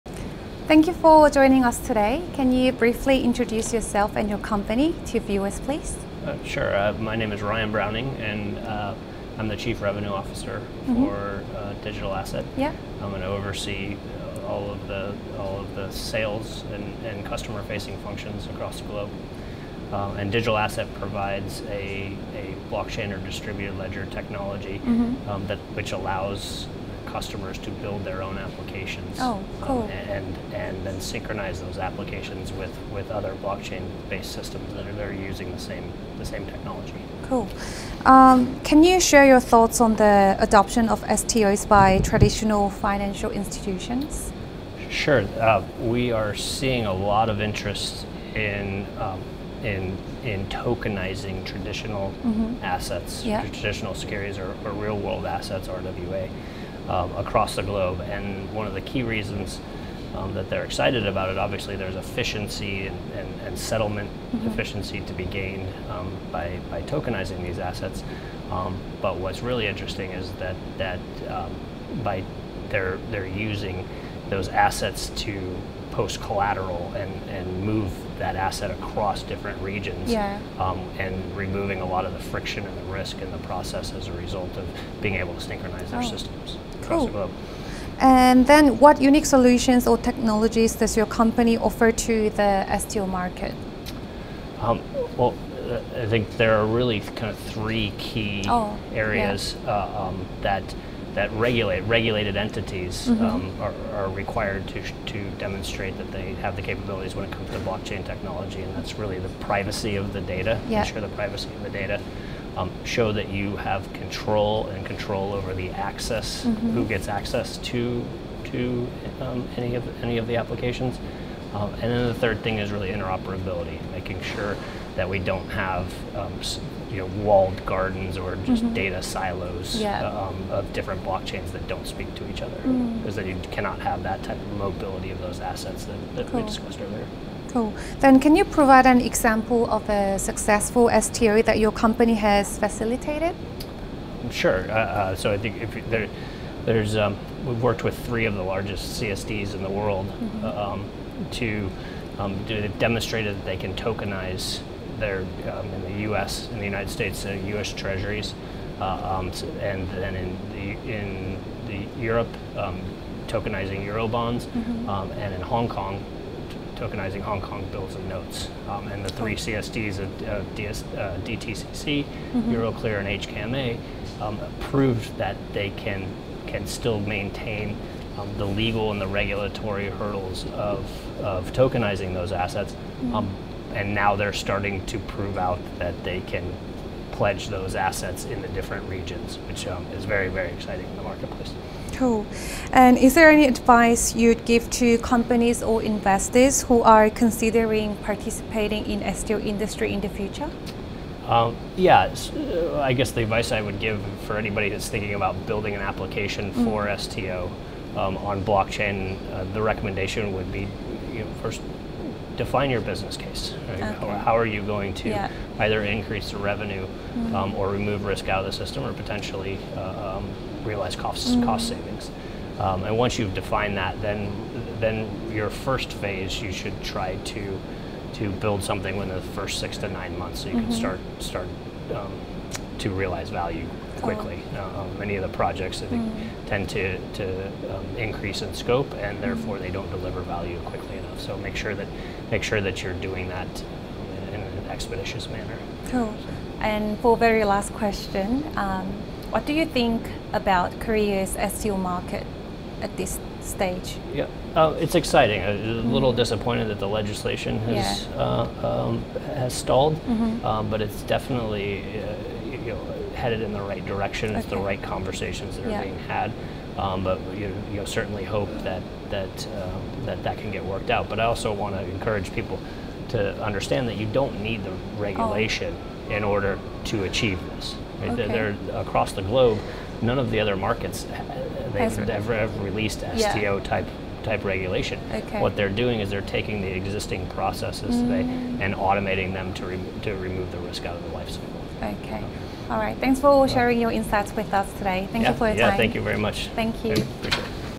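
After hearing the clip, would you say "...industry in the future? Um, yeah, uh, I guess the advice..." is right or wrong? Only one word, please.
right.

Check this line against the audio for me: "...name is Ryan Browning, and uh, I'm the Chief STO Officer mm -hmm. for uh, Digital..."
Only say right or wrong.
wrong.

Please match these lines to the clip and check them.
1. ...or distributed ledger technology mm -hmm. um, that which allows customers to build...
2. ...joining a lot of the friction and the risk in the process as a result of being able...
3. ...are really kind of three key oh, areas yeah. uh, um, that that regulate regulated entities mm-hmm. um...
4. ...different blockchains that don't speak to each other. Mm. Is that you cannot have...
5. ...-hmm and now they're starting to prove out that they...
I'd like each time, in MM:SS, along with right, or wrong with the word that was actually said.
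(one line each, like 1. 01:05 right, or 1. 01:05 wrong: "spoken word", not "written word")
1. 00:23 right
2. 01:21 wrong: "removing", not "joining"
3. 01:36 right
4. 02:10 right
5. 03:03 right.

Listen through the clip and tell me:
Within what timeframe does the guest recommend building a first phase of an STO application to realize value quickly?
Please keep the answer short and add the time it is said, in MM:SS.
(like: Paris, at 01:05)
6 to 9 months, at 03:49.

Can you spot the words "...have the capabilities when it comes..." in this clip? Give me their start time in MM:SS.
01:46.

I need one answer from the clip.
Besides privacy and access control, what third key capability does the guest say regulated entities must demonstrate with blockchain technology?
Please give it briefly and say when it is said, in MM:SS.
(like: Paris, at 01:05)
Interoperability, at 02:02.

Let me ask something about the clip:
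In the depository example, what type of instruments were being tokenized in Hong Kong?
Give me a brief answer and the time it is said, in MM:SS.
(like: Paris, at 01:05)
Hong Kong bills and notes, at 02:47.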